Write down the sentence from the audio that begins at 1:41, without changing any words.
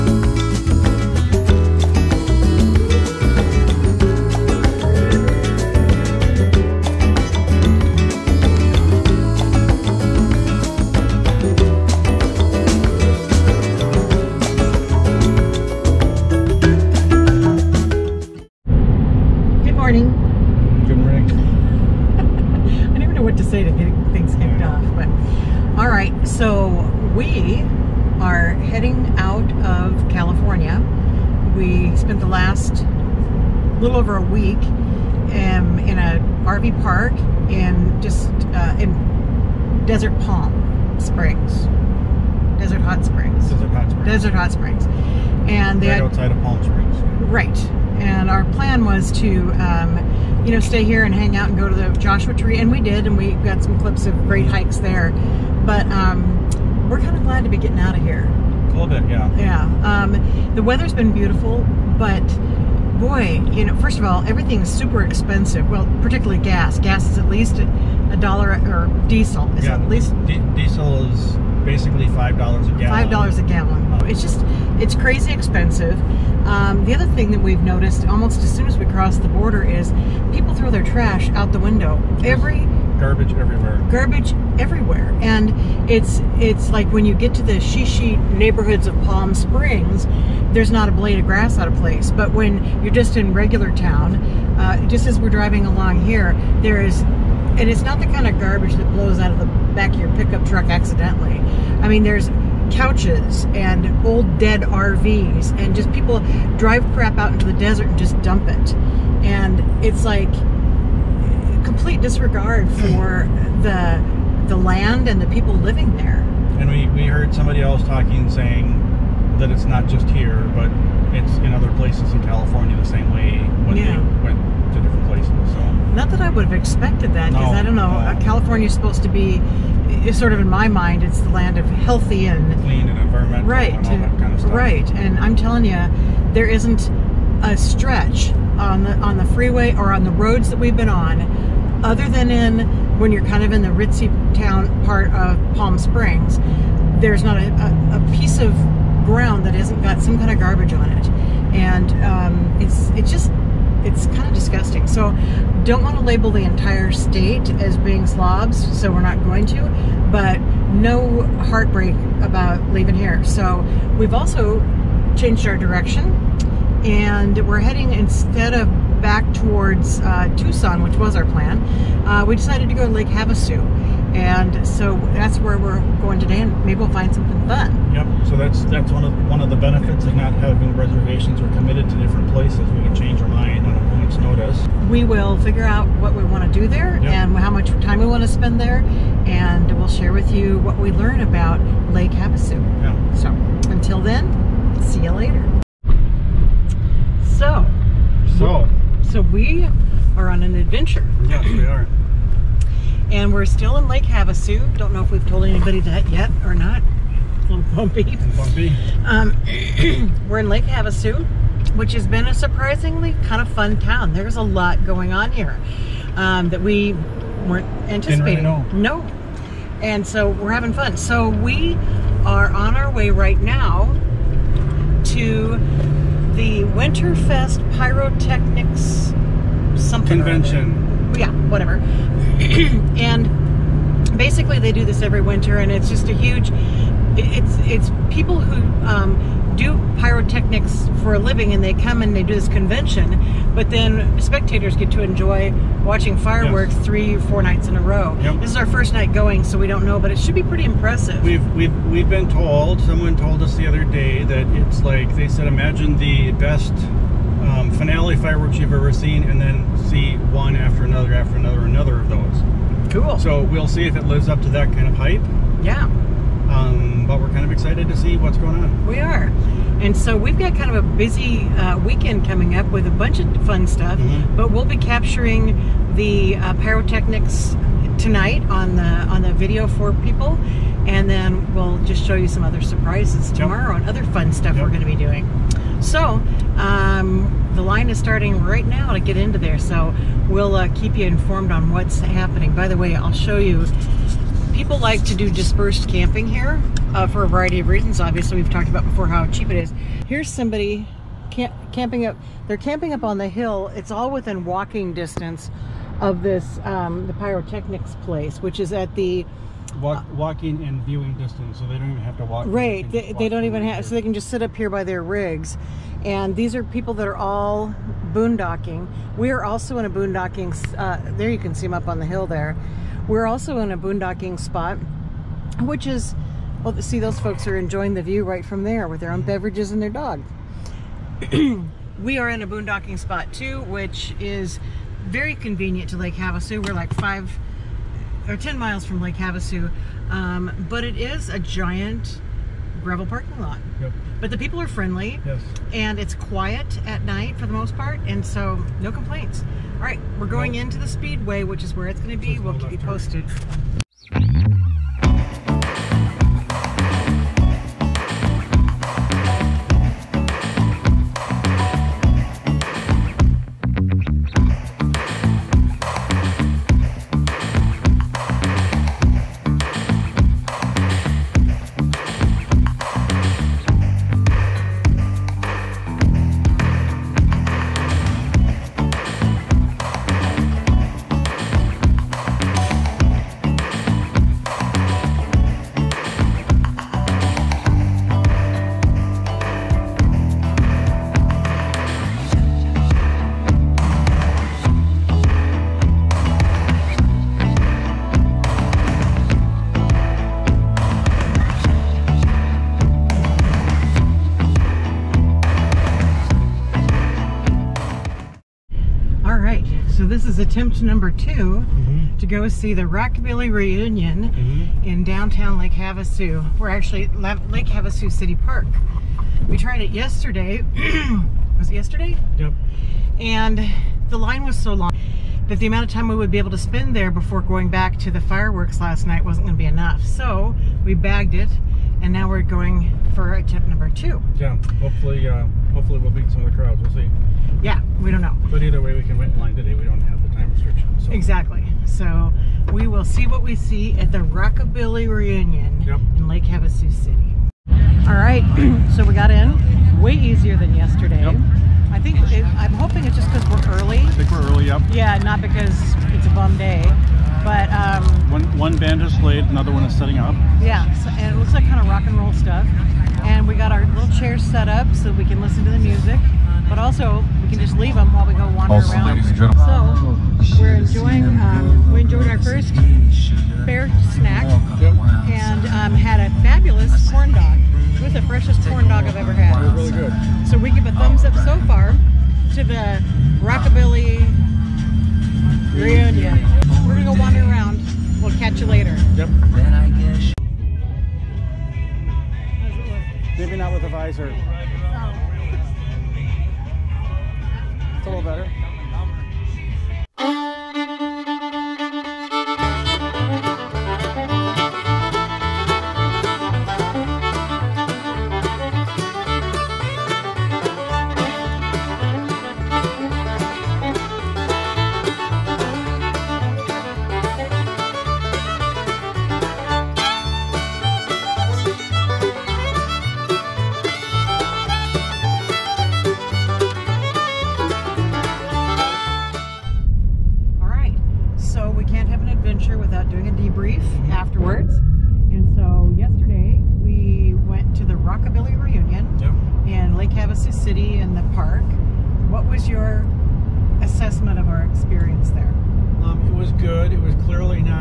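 I mean, there's couches and old dead RVs and just people drive crap out into the desert and just dump it.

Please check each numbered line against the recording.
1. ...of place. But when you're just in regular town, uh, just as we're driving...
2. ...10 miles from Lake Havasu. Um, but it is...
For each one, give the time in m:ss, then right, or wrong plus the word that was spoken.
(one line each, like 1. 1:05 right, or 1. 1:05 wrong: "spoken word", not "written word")
1. 1:31 right
2. 5:38 right.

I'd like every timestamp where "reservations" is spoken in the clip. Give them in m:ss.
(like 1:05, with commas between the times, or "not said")
3:00.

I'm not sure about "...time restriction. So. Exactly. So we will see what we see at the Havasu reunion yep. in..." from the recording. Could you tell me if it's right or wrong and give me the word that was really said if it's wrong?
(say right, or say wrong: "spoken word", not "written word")
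wrong: "Rockabilly", not "Havasu".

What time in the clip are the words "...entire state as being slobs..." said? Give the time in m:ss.
2:36.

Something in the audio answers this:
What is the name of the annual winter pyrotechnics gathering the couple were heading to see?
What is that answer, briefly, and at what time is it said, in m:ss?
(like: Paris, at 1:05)
Winterfest, at 3:46.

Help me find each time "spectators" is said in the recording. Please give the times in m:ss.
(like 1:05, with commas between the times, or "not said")
4:04.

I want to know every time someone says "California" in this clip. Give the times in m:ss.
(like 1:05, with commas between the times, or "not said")
2:02, 2:08.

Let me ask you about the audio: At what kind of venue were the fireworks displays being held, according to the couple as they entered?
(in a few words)
speedway.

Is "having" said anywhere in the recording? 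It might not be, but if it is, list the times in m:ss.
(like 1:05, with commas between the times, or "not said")
3:00, 3:40.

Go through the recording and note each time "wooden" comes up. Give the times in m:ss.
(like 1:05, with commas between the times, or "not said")
not said.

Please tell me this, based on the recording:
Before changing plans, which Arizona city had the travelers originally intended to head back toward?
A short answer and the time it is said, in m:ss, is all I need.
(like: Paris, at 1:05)
Tucson, at 2:50.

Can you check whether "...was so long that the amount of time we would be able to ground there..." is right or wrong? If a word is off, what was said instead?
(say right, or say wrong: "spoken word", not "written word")
wrong: "spend", not "ground".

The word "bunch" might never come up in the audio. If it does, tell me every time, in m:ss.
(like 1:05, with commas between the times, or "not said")
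4:32.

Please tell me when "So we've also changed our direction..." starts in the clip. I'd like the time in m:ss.
2:43.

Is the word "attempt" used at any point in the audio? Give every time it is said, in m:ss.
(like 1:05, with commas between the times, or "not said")
6:50, 7:13.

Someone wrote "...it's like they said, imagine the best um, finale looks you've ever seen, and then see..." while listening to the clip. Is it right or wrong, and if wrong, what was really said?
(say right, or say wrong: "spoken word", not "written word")
wrong: "fireworks", not "looks".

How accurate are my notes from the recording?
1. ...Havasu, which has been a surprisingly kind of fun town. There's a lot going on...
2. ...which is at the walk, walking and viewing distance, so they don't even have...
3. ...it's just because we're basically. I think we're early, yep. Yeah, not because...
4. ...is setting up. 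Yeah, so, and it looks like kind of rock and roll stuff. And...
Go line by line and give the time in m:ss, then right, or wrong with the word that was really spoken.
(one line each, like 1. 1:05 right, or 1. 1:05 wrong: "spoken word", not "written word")
1. 3:30 right
2. 5:08 right
3. 7:33 wrong: "early", not "basically"
4. 7:39 right.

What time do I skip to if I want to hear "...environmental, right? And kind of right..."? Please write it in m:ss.
2:12.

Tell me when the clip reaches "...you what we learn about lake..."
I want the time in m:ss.
3:10.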